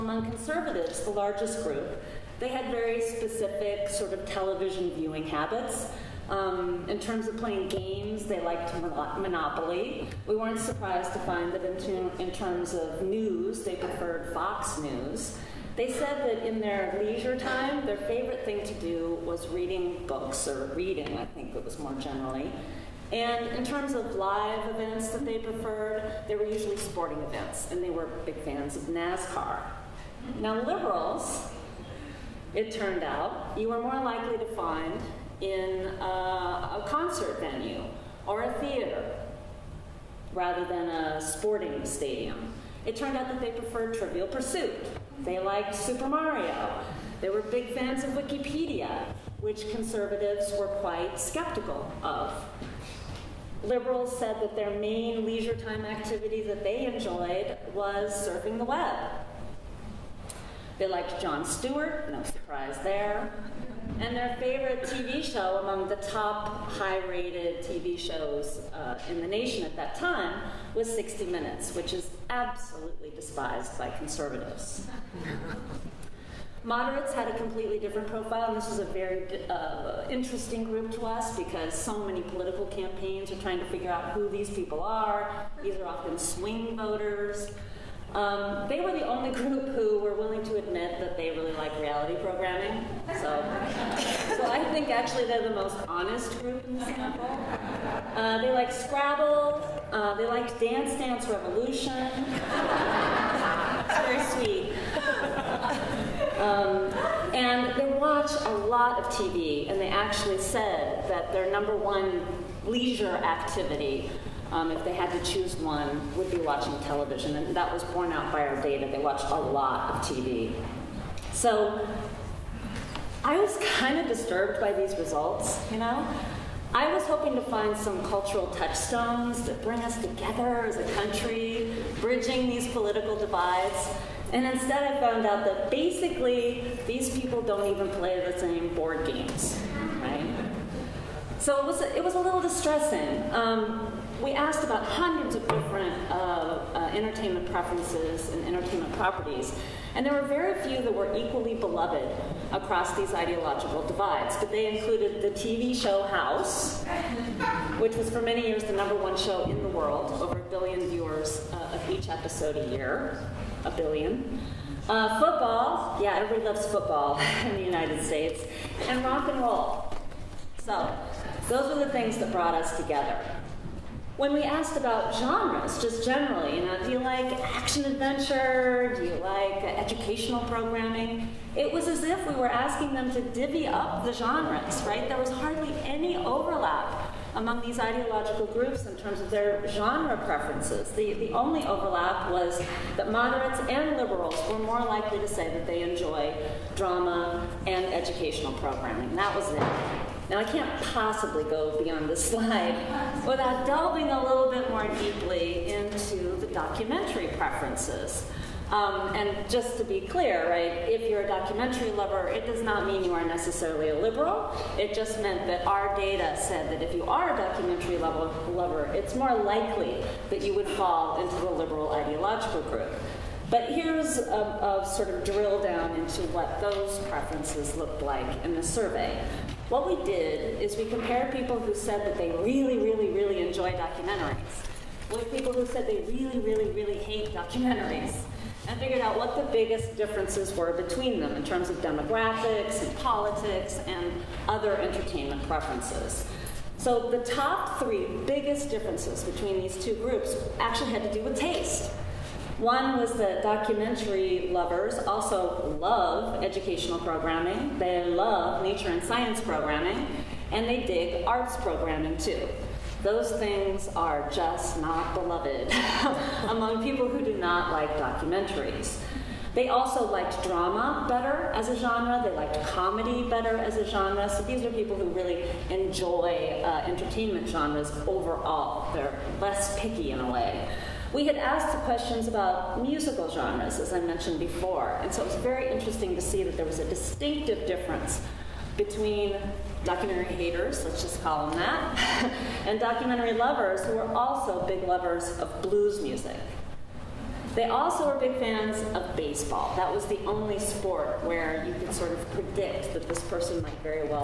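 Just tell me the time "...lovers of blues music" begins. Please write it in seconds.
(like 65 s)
294 s.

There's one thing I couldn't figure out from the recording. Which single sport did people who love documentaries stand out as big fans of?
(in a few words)
Baseball.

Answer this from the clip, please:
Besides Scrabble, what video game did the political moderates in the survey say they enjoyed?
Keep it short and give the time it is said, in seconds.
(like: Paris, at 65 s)
Dance Dance Revolution, at 100 s.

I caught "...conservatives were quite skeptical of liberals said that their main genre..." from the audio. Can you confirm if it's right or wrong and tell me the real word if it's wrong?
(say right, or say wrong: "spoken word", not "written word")
wrong: "leisure", not "genre".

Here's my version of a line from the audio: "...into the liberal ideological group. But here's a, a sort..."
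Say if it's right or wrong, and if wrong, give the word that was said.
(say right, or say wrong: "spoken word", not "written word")
right.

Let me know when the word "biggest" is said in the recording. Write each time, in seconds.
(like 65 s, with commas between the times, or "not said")
239 s, 248 s.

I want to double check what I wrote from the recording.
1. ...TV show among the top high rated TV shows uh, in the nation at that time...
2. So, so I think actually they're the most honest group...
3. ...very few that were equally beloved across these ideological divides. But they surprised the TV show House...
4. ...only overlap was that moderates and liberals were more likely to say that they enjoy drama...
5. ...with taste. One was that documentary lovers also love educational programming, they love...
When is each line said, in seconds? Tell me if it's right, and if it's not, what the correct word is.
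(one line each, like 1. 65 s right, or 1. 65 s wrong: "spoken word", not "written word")
1. 64 s right
2. 93 s right
3. 150 s wrong: "included", not "surprised"
4. 191 s right
5. 251 s right.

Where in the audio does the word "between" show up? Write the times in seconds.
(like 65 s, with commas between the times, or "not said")
240 s, 249 s, 288 s.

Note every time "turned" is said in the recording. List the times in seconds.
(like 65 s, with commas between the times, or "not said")
32 s, 42 s.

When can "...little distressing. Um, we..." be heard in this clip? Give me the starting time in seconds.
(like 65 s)
142 s.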